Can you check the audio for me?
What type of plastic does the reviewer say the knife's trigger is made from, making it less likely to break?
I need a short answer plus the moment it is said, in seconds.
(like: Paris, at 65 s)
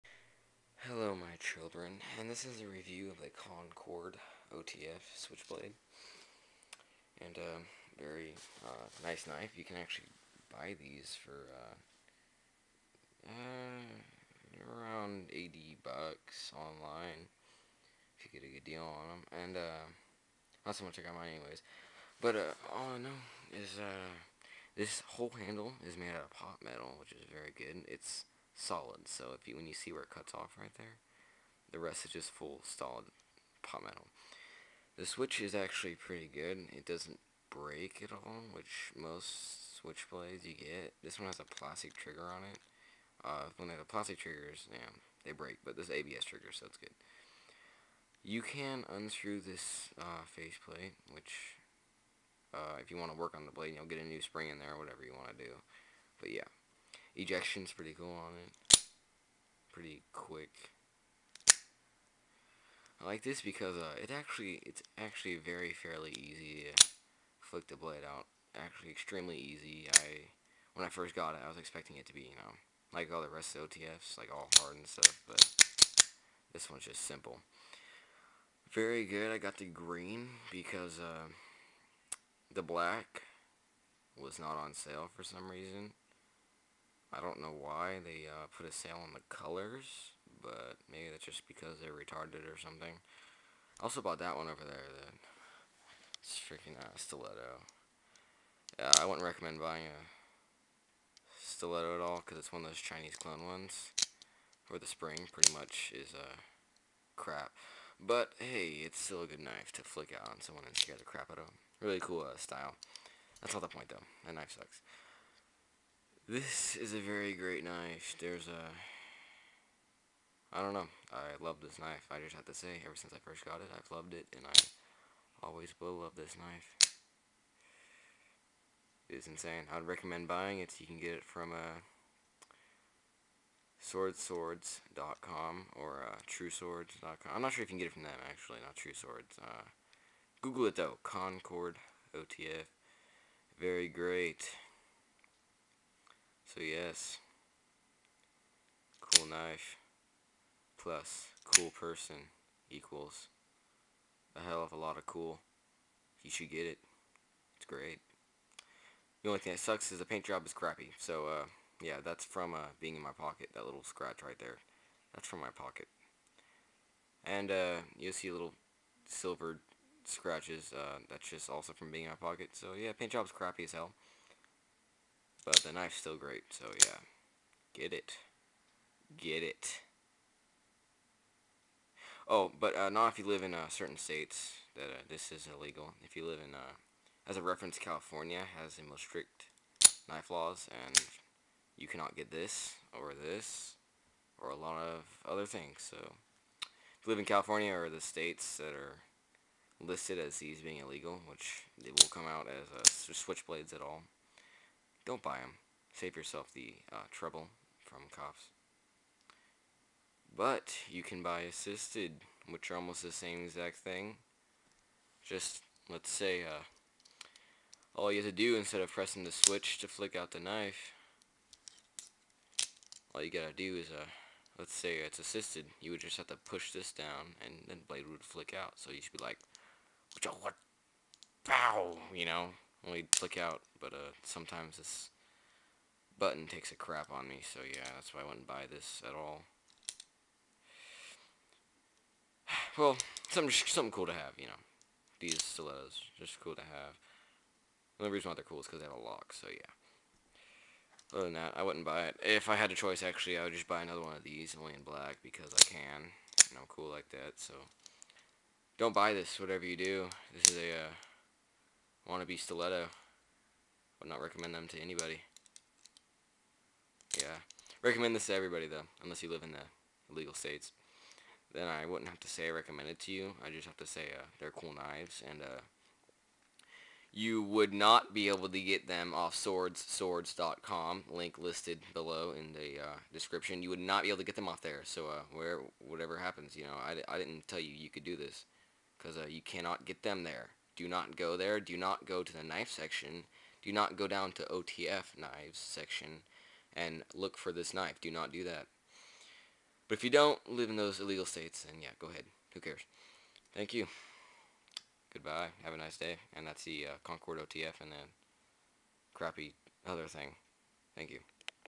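ABS, at 45 s.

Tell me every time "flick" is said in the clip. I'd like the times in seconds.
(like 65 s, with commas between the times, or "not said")
67 s, 109 s, 219 s, 228 s, 233 s.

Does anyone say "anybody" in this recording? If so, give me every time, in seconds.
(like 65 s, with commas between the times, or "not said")
264 s.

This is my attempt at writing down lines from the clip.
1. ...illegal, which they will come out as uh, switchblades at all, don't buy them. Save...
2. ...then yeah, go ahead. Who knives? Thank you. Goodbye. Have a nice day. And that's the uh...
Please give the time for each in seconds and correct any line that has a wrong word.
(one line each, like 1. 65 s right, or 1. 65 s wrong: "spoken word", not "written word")
1. 200 s right
2. 301 s wrong: "cares", not "knives".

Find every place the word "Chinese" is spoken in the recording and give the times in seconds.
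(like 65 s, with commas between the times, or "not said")
102 s.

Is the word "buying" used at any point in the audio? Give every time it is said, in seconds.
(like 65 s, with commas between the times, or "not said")
99 s, 130 s.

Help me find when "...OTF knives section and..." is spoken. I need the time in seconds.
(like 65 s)
294 s.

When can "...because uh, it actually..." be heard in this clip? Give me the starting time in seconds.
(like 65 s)
63 s.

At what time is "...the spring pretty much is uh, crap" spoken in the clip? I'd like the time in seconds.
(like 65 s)
104 s.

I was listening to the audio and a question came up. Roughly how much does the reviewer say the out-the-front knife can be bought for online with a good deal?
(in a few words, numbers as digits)
$80.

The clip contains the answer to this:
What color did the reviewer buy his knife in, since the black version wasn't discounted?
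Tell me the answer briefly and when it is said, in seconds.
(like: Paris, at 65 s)
Green, at 79 s.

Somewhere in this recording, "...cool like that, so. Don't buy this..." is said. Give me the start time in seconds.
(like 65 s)
256 s.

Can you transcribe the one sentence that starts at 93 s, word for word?
I also bought that one over there, the it's freaking uh, stiletto.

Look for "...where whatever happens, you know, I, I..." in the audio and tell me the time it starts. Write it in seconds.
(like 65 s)
285 s.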